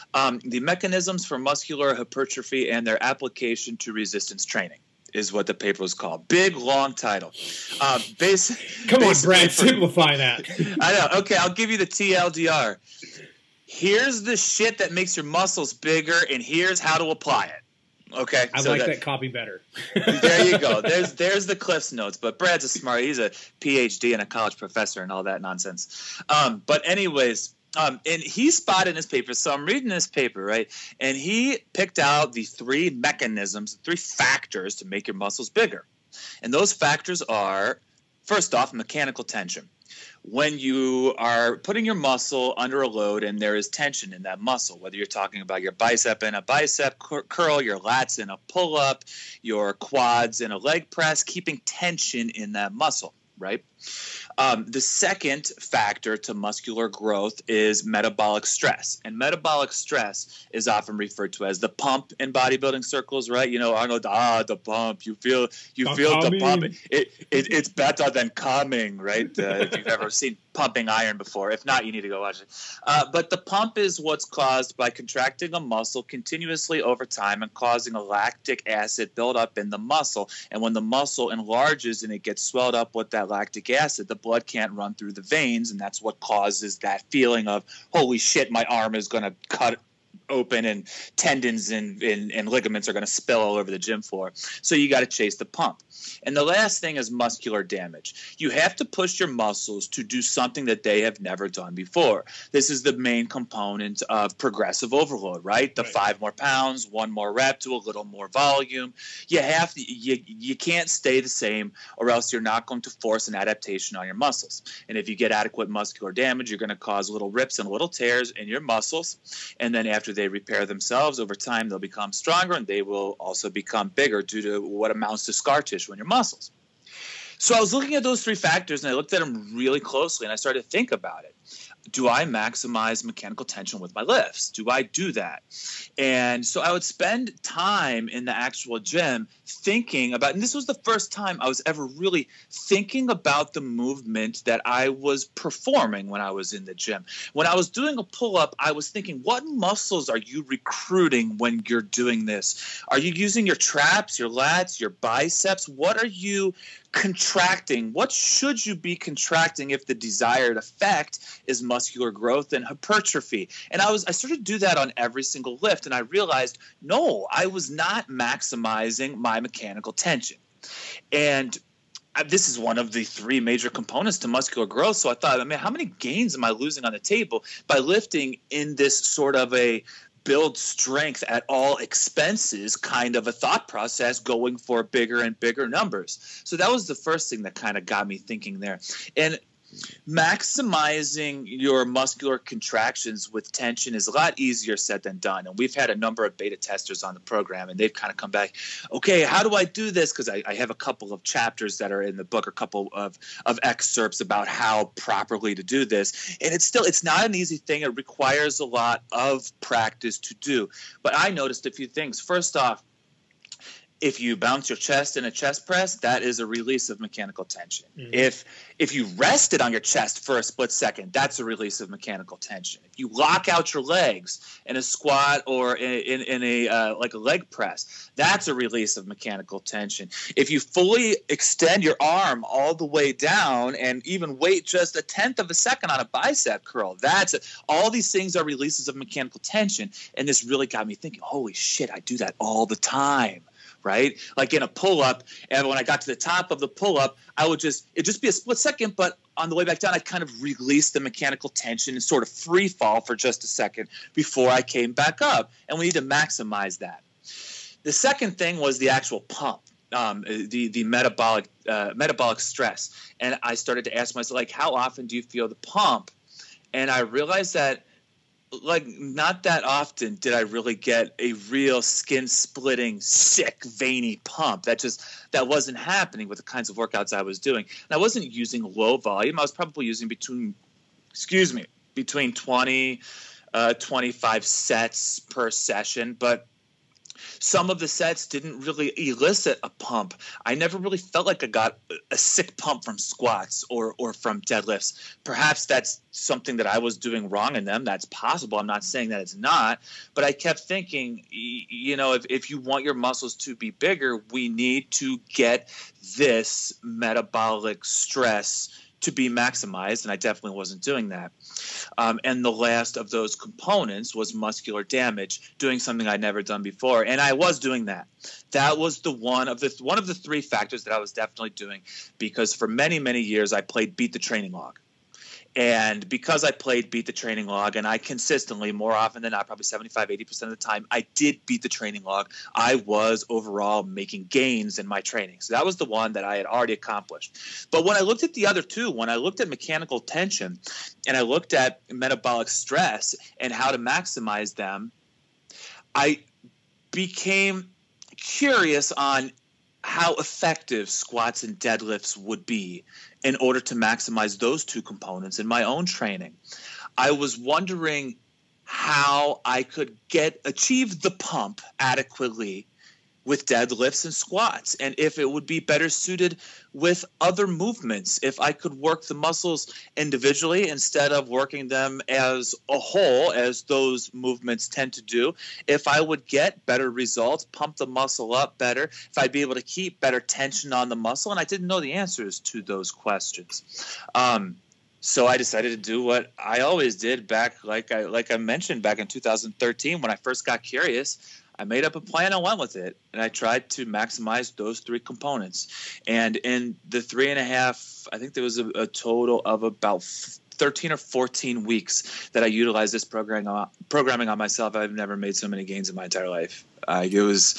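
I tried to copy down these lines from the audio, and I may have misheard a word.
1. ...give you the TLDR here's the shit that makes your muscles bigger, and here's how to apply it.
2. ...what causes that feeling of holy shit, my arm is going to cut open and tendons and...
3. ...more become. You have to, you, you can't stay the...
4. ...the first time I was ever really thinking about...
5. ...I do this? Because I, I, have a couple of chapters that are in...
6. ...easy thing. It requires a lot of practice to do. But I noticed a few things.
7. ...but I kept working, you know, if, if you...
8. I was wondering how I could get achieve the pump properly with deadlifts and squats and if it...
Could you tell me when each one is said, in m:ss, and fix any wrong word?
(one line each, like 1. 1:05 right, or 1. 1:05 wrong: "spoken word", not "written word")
1. 0:11 right
2. 1:26 right
3. 1:48 wrong: "volume", not "become"
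4. 2:20 right
5. 3:19 right
6. 3:27 right
7. 5:00 wrong: "thinking", not "working"
8. 5:56 wrong: "adequately", not "properly".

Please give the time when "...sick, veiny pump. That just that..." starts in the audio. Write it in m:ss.
4:33.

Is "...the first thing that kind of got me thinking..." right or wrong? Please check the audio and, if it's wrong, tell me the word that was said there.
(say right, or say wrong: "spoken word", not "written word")
right.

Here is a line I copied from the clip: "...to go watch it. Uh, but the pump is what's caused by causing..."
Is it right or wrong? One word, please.
wrong.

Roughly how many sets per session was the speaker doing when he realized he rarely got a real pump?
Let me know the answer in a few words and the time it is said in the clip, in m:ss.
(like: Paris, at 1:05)
25, at 4:43.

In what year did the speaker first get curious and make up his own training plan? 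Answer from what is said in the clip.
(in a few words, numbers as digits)
2013.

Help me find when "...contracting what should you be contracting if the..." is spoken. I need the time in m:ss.
2:36.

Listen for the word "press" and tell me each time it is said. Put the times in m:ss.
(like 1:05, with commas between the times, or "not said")
0:50, 3:35, 3:47.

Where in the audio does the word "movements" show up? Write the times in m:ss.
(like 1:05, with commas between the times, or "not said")
2:23, 6:07, 6:14.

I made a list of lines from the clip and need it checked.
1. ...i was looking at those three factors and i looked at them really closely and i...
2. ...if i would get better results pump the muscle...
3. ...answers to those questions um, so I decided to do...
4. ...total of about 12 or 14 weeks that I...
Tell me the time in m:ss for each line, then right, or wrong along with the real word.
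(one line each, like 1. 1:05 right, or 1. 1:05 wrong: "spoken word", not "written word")
1. 2:07 right
2. 6:15 right
3. 6:21 right
4. 6:38 wrong: "13", not "12".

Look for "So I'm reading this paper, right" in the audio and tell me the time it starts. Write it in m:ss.
0:29.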